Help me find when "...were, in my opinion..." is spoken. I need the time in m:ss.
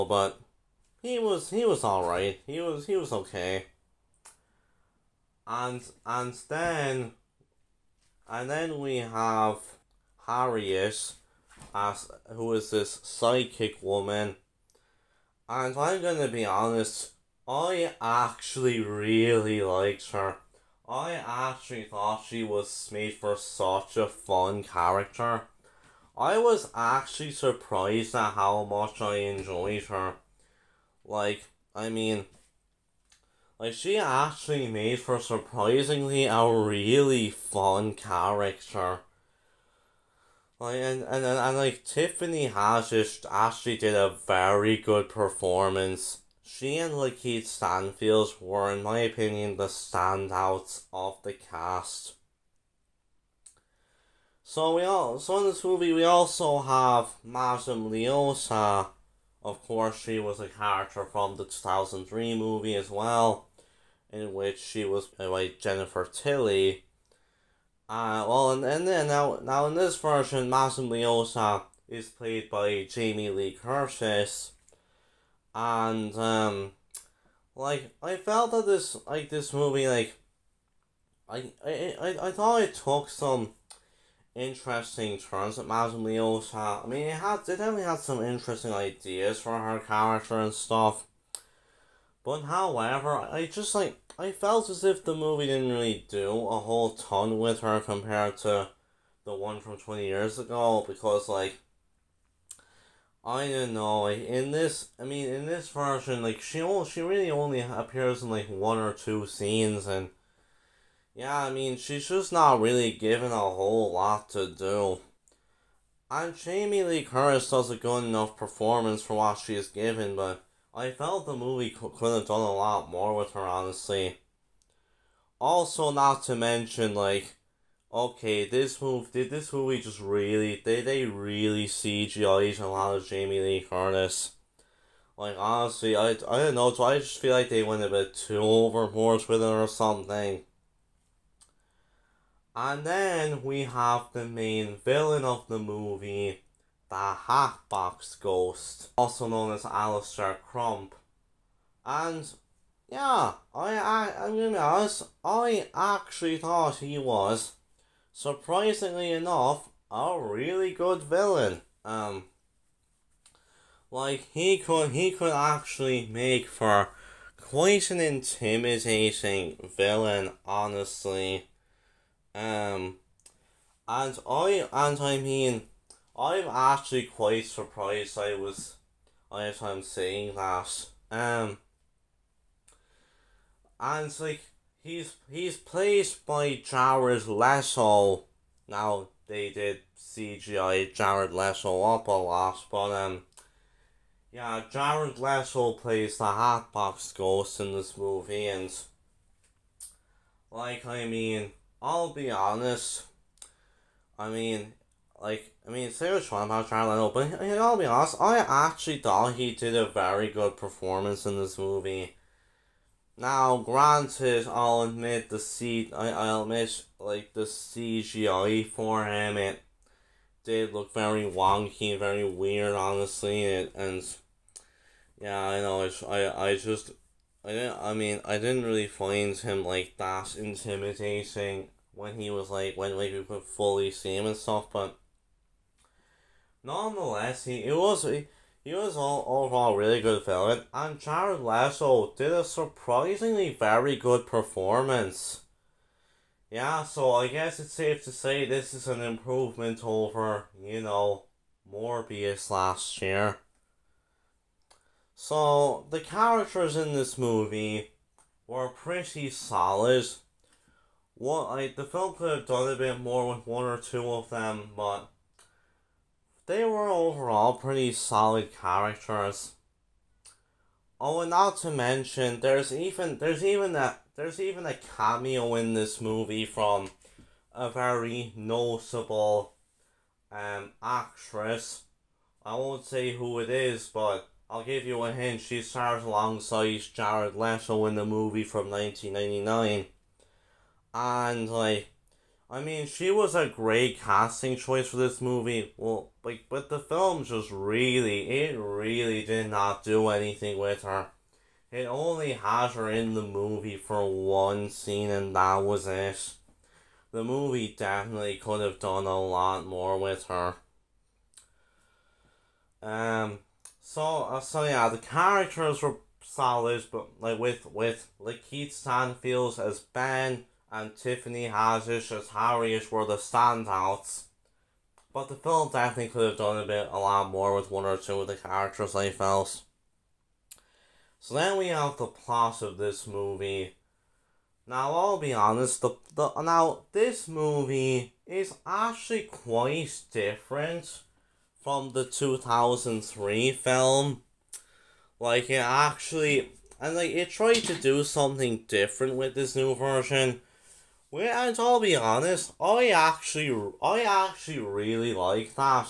0:48.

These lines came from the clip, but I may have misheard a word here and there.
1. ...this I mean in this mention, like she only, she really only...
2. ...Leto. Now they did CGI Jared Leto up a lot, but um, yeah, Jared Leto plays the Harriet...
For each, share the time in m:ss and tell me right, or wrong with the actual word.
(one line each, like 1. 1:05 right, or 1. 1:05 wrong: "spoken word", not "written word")
1. 1:44 wrong: "version", not "mention"
2. 3:07 wrong: "Hatbox", not "Harriet".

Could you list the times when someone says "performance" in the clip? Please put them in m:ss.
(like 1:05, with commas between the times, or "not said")
0:45, 1:58, 3:30, 4:04.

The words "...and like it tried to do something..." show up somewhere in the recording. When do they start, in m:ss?
5:46.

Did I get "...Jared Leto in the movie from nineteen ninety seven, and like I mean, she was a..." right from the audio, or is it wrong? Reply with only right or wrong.
wrong.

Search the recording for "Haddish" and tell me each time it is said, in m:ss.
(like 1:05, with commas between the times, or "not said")
0:42, 5:21.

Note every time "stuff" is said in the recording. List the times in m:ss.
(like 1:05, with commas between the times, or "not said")
1:30, 3:54.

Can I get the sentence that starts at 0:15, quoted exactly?
And I'm gonna be honest, I actually really liked her.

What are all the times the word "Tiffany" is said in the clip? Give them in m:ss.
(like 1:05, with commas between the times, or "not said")
0:41, 5:20.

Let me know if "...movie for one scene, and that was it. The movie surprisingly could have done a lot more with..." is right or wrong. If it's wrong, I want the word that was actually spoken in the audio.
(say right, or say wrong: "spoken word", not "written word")
wrong: "definitely", not "surprisingly".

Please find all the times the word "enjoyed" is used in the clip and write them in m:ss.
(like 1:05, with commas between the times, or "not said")
0:29.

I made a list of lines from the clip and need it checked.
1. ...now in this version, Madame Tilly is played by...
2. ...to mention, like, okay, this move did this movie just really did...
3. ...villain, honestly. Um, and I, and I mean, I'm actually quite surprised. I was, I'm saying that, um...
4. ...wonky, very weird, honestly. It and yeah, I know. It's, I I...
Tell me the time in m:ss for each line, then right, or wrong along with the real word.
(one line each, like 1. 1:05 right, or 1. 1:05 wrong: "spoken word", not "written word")
1. 1:09 wrong: "Leota", not "Tilly"
2. 2:06 right
3. 2:49 right
4. 3:41 right.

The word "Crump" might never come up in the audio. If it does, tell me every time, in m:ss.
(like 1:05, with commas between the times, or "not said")
2:30.